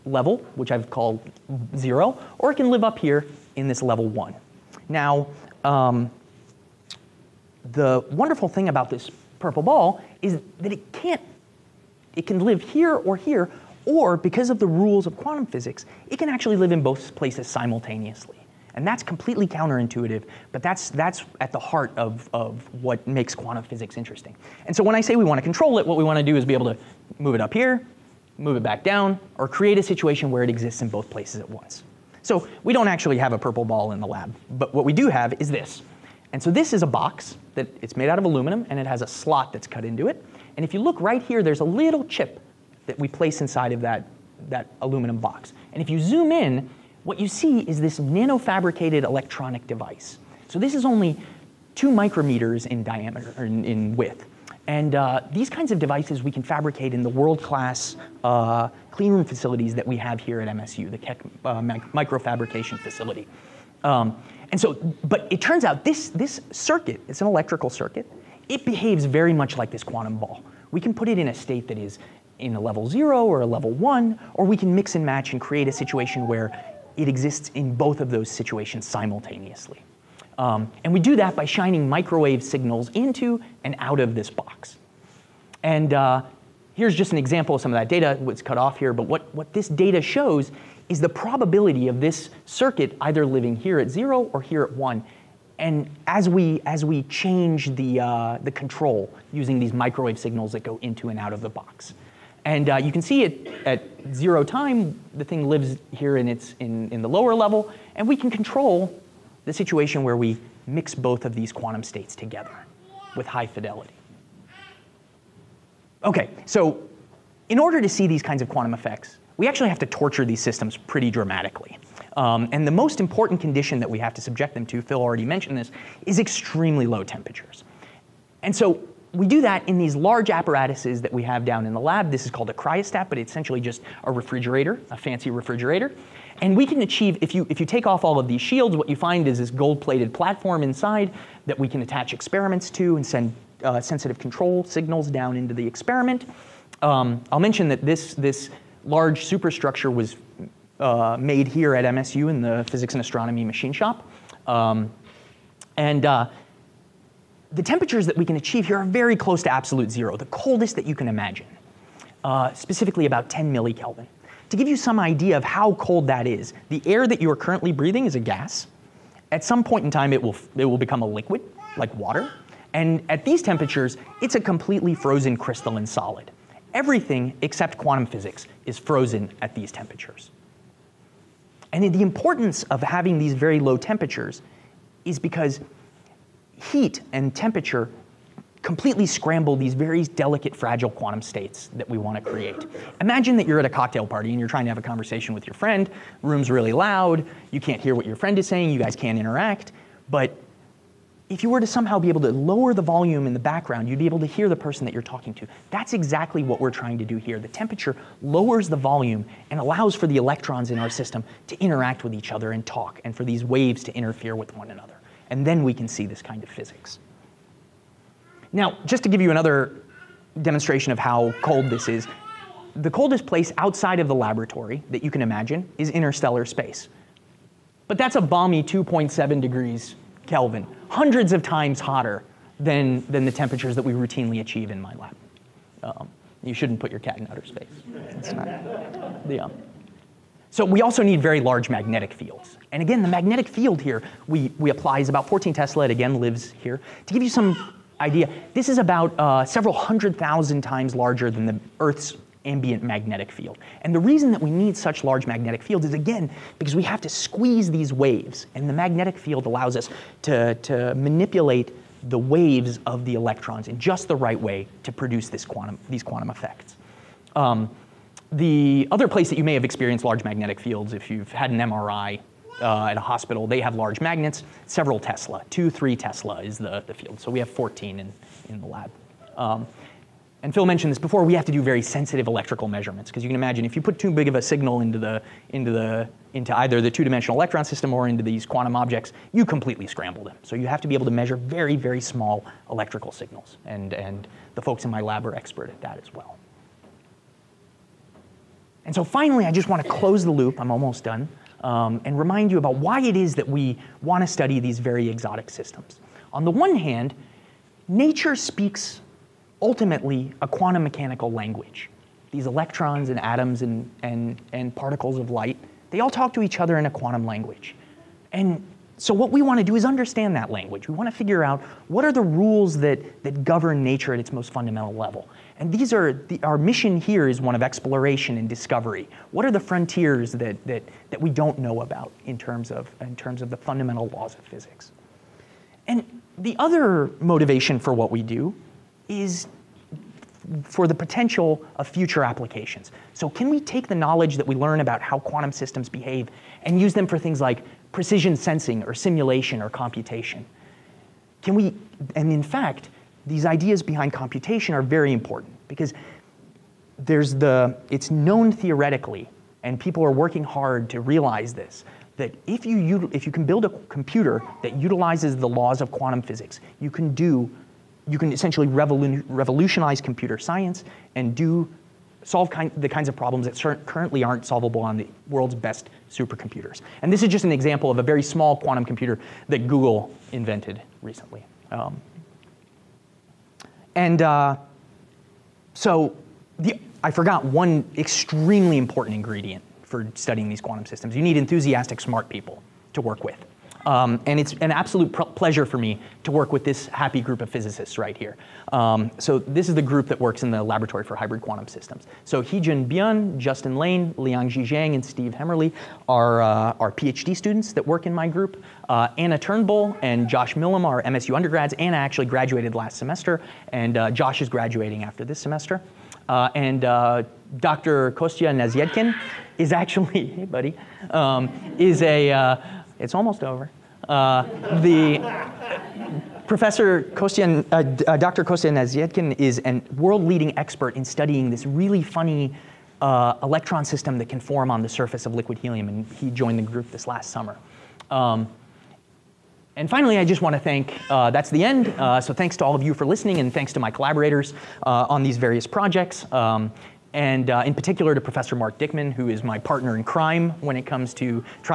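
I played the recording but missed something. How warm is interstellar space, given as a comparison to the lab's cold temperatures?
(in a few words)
2.7 Kelvin.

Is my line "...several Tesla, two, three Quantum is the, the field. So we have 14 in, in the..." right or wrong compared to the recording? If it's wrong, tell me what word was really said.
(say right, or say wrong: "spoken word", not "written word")
wrong: "Tesla", not "Quantum".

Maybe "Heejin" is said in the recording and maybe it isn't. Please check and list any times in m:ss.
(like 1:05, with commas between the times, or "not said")
6:42.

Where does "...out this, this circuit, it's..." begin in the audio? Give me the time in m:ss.
1:05.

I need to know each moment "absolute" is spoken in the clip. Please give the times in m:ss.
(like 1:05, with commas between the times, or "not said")
2:39, 6:34.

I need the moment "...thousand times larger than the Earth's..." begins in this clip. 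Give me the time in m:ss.
4:10.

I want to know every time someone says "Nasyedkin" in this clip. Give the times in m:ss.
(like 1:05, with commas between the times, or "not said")
6:58, 7:08.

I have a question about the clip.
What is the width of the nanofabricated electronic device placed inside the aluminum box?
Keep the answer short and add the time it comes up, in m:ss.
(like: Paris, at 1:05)
2 micrometers, at 0:51.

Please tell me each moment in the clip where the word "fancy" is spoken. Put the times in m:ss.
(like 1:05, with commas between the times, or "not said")
2:14.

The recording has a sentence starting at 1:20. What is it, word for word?
Um, and we do that by shining microwave signals into and out of this box.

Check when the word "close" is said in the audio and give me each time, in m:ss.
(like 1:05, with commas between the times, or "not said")
2:39, 4:59.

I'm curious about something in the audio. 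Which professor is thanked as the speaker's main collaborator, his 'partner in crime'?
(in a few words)
Mark Dykman.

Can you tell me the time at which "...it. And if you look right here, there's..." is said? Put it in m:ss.
0:40.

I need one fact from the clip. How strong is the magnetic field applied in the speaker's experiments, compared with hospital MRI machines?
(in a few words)
14 Tesla.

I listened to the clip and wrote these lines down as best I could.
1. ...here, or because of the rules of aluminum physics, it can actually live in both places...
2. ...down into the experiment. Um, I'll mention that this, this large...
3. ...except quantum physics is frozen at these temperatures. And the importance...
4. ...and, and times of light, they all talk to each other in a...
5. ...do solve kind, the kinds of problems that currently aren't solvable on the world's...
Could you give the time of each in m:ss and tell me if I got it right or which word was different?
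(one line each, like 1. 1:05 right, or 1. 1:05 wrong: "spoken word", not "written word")
1. 0:13 wrong: "quantum", not "aluminum"
2. 2:25 right
3. 2:57 right
4. 5:14 wrong: "particles", not "times"
5. 6:11 right.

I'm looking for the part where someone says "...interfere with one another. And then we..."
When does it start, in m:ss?
3:33.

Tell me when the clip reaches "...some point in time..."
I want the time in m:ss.
2:49.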